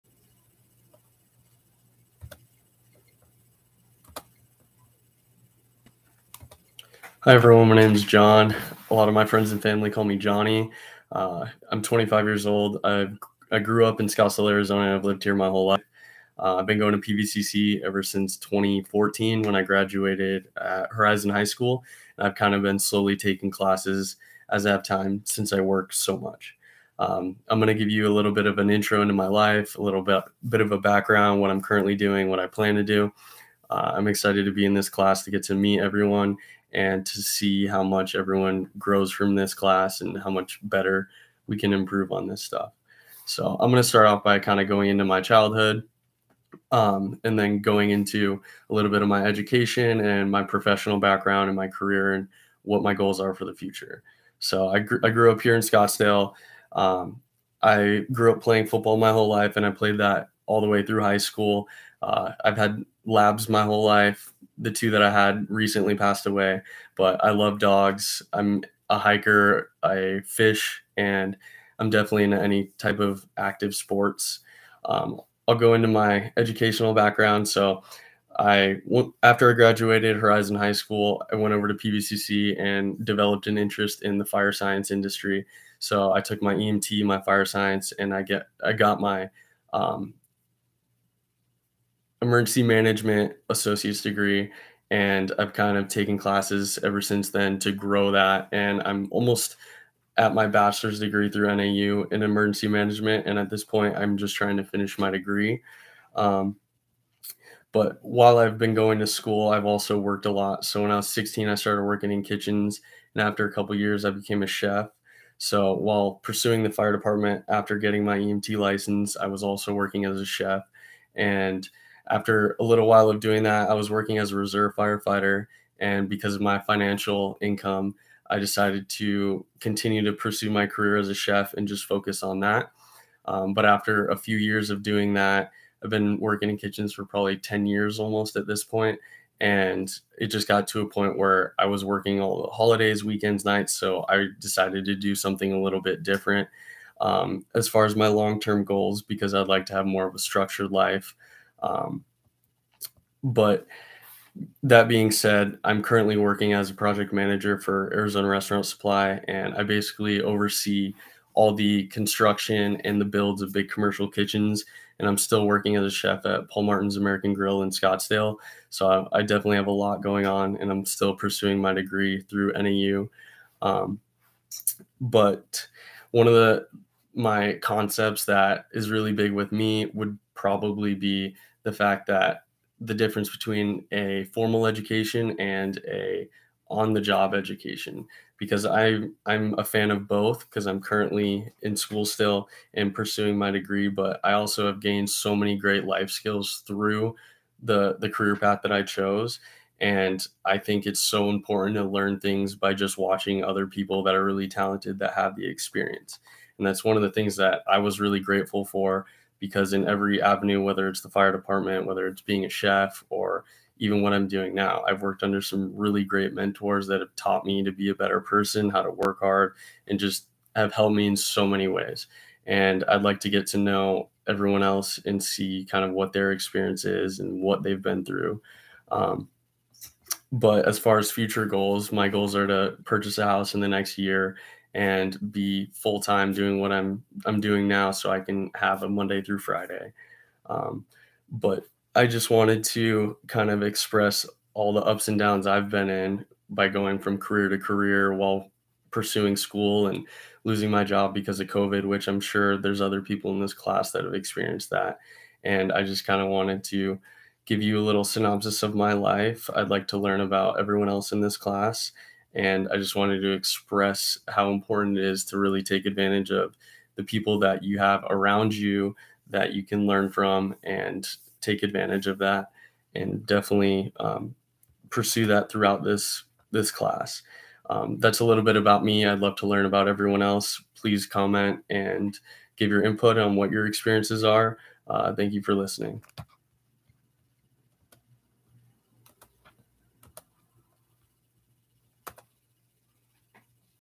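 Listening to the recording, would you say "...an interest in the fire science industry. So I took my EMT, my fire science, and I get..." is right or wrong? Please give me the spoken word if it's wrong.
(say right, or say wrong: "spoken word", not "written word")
right.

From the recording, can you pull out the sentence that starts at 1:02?
Uh, I've had labs my whole life the two that I had recently passed away, but I love dogs.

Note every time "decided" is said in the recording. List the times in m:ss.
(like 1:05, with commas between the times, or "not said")
2:08, 2:24.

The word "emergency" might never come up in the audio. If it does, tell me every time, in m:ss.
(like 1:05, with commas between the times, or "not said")
1:32, 1:42.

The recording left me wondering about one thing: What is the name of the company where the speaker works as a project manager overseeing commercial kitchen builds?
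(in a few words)
Arizona Restaurant Supply.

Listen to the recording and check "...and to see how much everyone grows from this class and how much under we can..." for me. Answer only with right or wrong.
wrong.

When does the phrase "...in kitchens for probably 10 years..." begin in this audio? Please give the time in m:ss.
2:16.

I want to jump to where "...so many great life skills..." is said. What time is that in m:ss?
3:15.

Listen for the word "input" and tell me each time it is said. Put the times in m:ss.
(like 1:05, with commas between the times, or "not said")
4:42.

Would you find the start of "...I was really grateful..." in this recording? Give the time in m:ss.
3:27.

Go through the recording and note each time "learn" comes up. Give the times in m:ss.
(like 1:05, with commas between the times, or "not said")
3:21, 4:19, 4:29, 4:39.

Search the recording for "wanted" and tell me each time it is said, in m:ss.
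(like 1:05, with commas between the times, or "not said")
4:02, 4:16, 4:22.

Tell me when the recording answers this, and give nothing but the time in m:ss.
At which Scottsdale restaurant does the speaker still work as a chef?
2:46.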